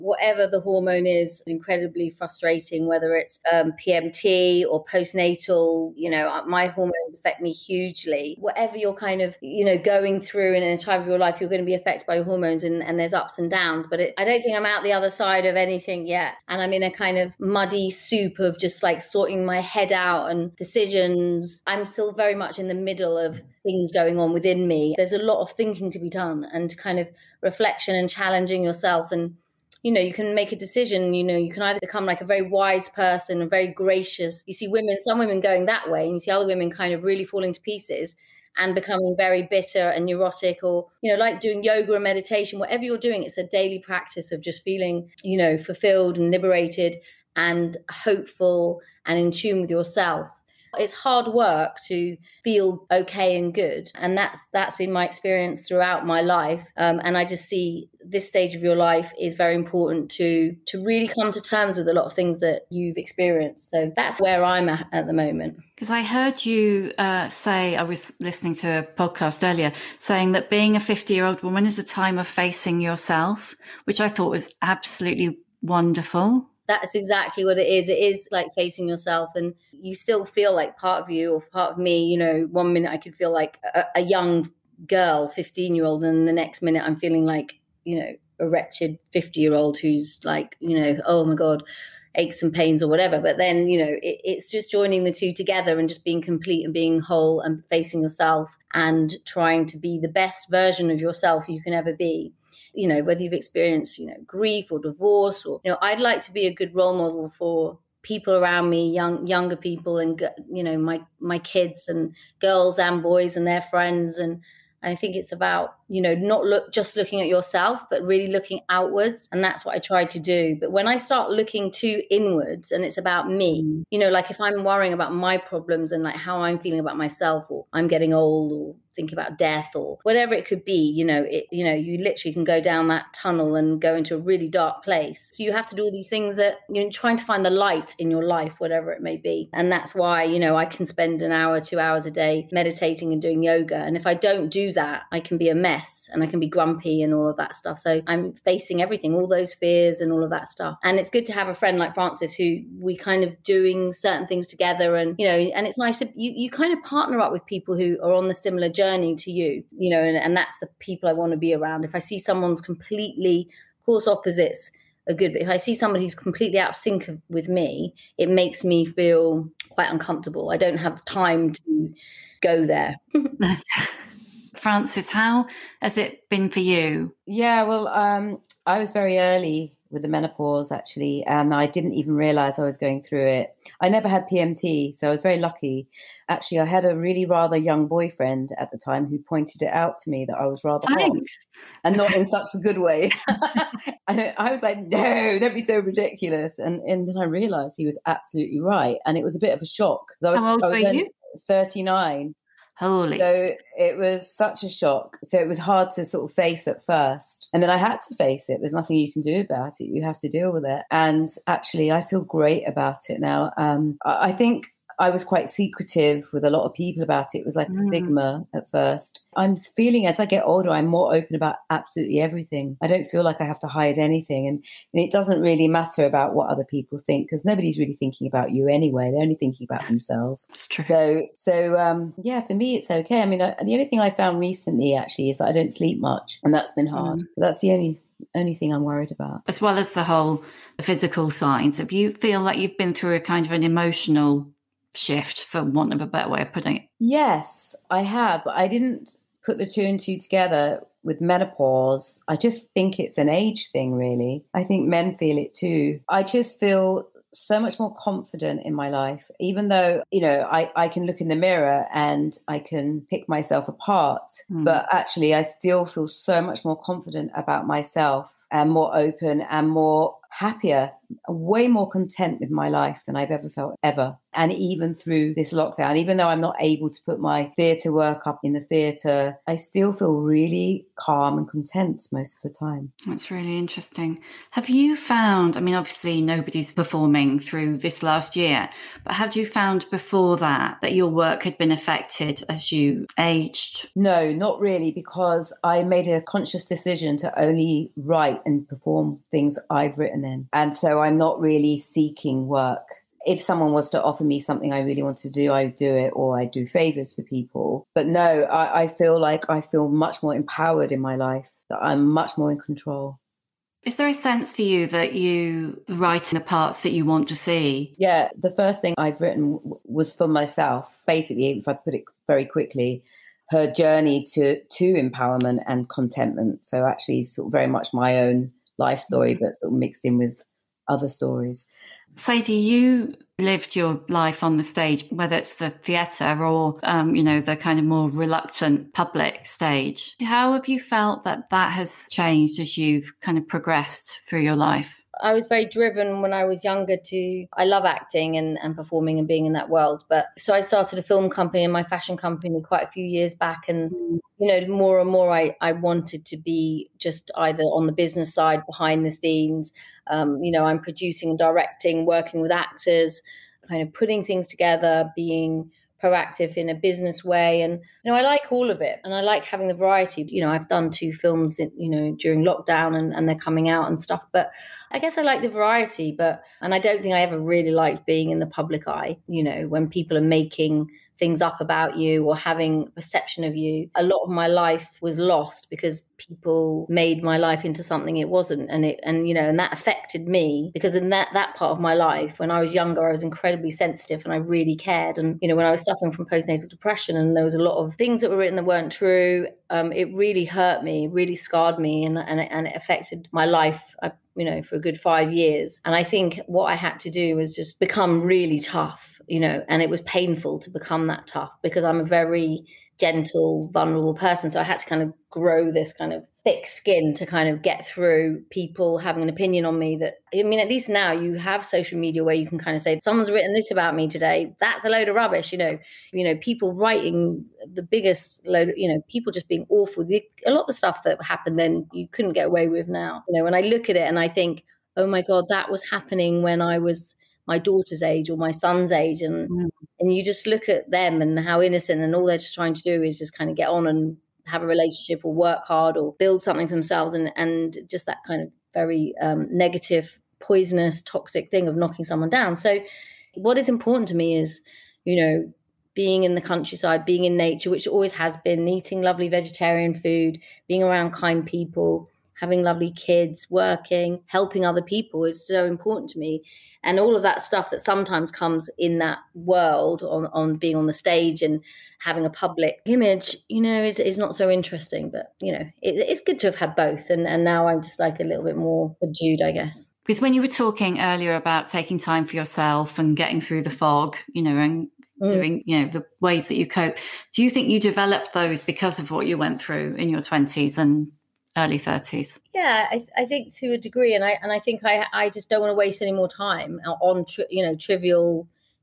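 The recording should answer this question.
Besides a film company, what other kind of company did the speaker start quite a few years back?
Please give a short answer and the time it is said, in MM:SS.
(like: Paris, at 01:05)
fashion company, at 05:51.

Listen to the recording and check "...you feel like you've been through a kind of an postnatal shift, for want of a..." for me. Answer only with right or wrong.
wrong.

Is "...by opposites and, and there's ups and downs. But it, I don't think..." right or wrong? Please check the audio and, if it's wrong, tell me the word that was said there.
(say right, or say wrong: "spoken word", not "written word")
wrong: "hormones", not "opposites".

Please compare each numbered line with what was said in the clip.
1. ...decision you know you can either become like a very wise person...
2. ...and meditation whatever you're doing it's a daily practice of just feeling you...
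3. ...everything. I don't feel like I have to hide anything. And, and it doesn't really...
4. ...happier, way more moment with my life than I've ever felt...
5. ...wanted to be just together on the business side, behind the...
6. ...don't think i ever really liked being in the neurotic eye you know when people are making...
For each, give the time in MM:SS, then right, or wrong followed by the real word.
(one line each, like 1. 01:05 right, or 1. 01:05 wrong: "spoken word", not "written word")
1. 00:30 right
2. 00:41 right
3. 03:42 right
4. 04:30 wrong: "content", not "moment"
5. 05:55 wrong: "either", not "together"
6. 06:16 wrong: "public", not "neurotic".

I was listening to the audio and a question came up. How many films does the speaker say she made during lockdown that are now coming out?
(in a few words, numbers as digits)
2.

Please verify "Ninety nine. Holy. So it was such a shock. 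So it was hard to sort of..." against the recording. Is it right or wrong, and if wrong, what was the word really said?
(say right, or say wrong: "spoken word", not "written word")
wrong: "Thirty", not "Ninety".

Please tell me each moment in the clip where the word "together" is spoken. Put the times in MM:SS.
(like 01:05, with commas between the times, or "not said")
01:35, 02:34, 04:10, 06:04.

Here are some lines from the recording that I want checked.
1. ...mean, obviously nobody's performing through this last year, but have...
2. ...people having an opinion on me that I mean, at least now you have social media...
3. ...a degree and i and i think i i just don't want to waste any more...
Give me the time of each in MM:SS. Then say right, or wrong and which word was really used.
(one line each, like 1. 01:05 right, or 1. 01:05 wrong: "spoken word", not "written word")
1. 04:45 right
2. 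06:58 right
3. 08:13 right.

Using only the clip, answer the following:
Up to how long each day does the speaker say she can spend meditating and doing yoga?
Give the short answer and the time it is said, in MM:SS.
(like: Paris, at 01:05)
2 hours, at 02:21.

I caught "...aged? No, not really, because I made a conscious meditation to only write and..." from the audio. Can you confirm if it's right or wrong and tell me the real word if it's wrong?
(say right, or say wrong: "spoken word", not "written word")
wrong: "decision", not "meditation".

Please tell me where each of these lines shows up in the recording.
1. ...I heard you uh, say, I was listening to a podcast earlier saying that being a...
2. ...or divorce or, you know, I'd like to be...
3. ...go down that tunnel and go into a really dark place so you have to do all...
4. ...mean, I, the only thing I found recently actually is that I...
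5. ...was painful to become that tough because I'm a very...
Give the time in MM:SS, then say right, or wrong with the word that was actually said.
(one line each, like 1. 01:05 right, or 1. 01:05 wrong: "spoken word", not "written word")
1. 01:05 right
2. 01:44 right
3. 02:12 right
4. 03:53 right
5. 06:49 right.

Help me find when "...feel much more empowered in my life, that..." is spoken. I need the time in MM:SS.
05:09.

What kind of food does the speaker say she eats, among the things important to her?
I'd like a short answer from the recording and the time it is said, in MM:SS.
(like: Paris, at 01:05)
vegetarian food, at 07:39.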